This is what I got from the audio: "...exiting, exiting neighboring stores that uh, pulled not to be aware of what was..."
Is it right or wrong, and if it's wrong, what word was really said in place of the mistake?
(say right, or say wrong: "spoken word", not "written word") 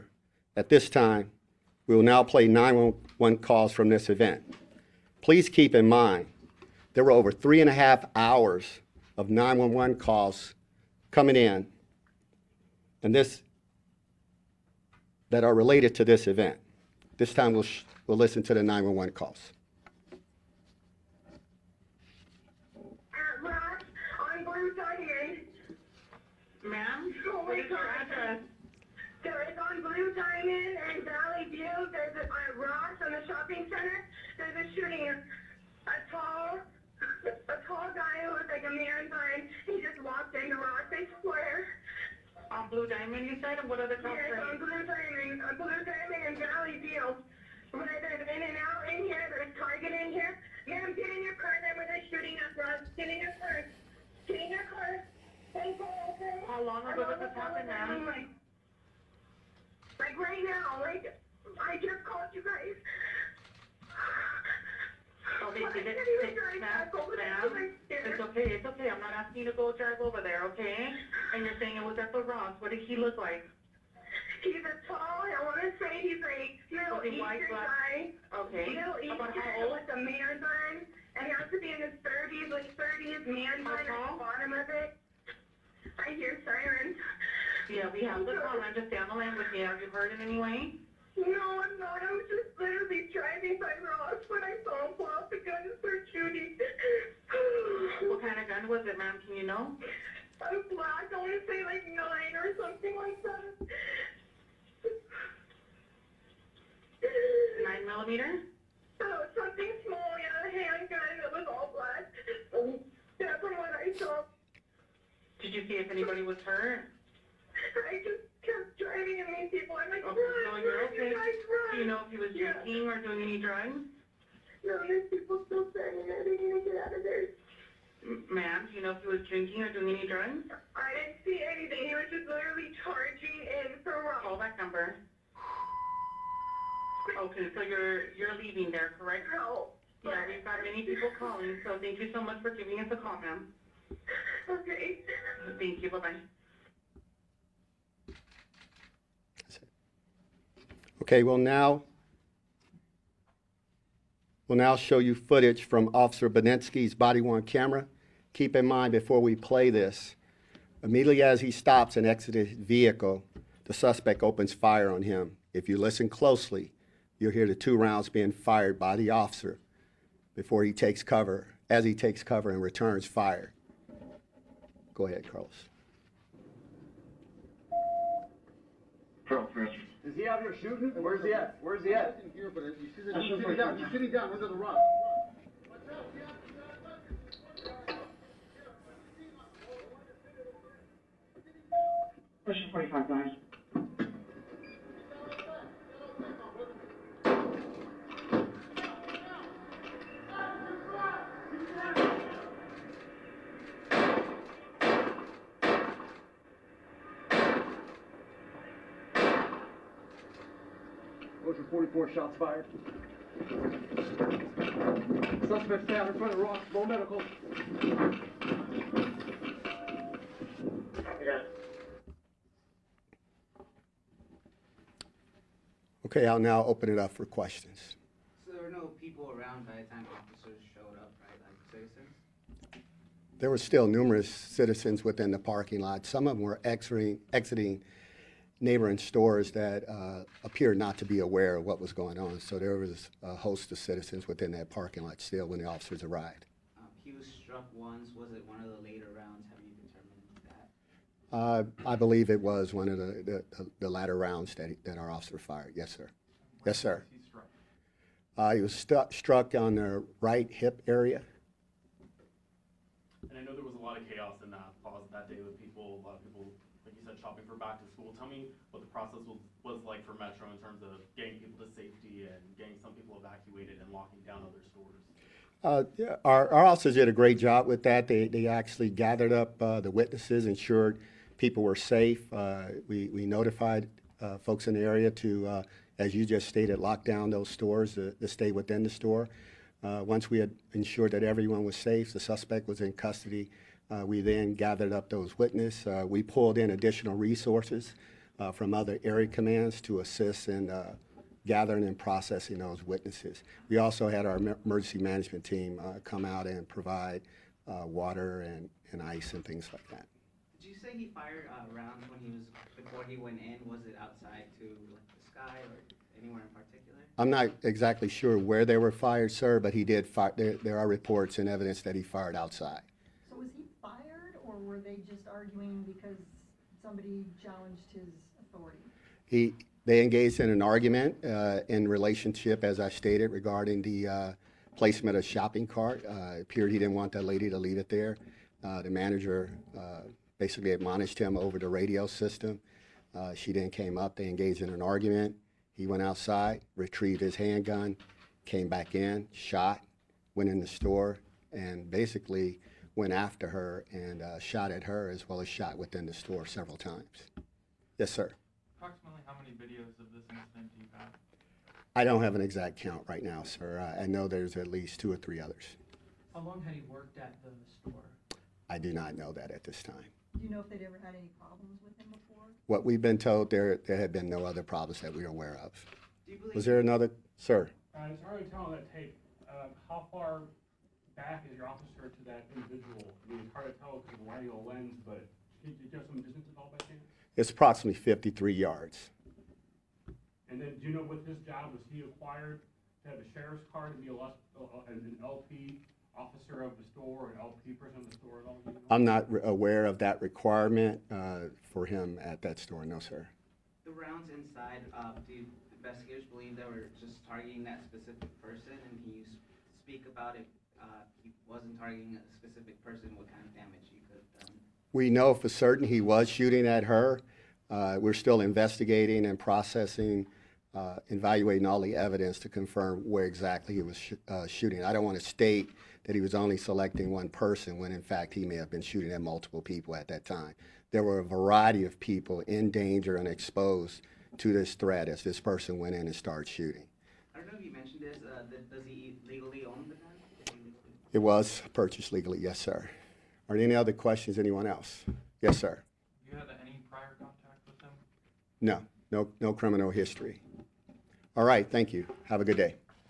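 wrong: "appeared", not "pulled".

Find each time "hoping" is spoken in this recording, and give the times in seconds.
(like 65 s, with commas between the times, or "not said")
not said.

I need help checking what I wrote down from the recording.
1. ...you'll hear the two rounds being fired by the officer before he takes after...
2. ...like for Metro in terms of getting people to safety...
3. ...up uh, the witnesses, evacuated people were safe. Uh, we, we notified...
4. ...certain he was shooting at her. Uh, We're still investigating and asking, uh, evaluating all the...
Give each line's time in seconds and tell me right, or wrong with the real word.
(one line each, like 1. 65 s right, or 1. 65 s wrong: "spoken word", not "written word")
1. 167 s wrong: "cover", not "after"
2. 269 s right
3. 279 s wrong: "ensured", not "evacuated"
4. 415 s wrong: "processing", not "asking".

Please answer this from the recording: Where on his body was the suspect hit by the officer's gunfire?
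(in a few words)
Right hip.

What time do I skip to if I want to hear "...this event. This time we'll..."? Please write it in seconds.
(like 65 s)
16 s.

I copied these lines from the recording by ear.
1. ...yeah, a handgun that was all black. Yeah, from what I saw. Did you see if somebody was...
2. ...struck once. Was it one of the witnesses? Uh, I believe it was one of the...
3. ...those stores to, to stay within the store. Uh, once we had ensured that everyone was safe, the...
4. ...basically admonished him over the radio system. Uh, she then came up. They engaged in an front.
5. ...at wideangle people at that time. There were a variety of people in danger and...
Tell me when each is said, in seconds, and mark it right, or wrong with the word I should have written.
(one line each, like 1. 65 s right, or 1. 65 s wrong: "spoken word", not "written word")
1. 110 s wrong: "anybody", not "somebody"
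2. 247 s wrong: "ladies", not "witnesses"
3. 287 s right
4. 340 s wrong: "argument", not "front"
5. 429 s wrong: "multiple", not "wideangle".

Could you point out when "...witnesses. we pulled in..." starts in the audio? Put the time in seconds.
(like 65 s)
295 s.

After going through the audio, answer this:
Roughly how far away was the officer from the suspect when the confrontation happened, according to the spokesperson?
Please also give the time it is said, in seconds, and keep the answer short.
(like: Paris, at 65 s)
53 yards, at 387 s.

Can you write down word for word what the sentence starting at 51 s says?
Then when they're shooting up, Rob, get in your car.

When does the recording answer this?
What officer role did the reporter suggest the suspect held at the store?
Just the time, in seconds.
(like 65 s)
395 s.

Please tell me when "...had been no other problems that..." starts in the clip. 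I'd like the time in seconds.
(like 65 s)
373 s.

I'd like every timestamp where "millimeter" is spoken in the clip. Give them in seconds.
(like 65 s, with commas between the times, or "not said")
107 s.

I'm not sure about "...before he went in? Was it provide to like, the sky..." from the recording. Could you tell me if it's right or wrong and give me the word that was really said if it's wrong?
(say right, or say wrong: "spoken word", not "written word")
wrong: "outside", not "provide".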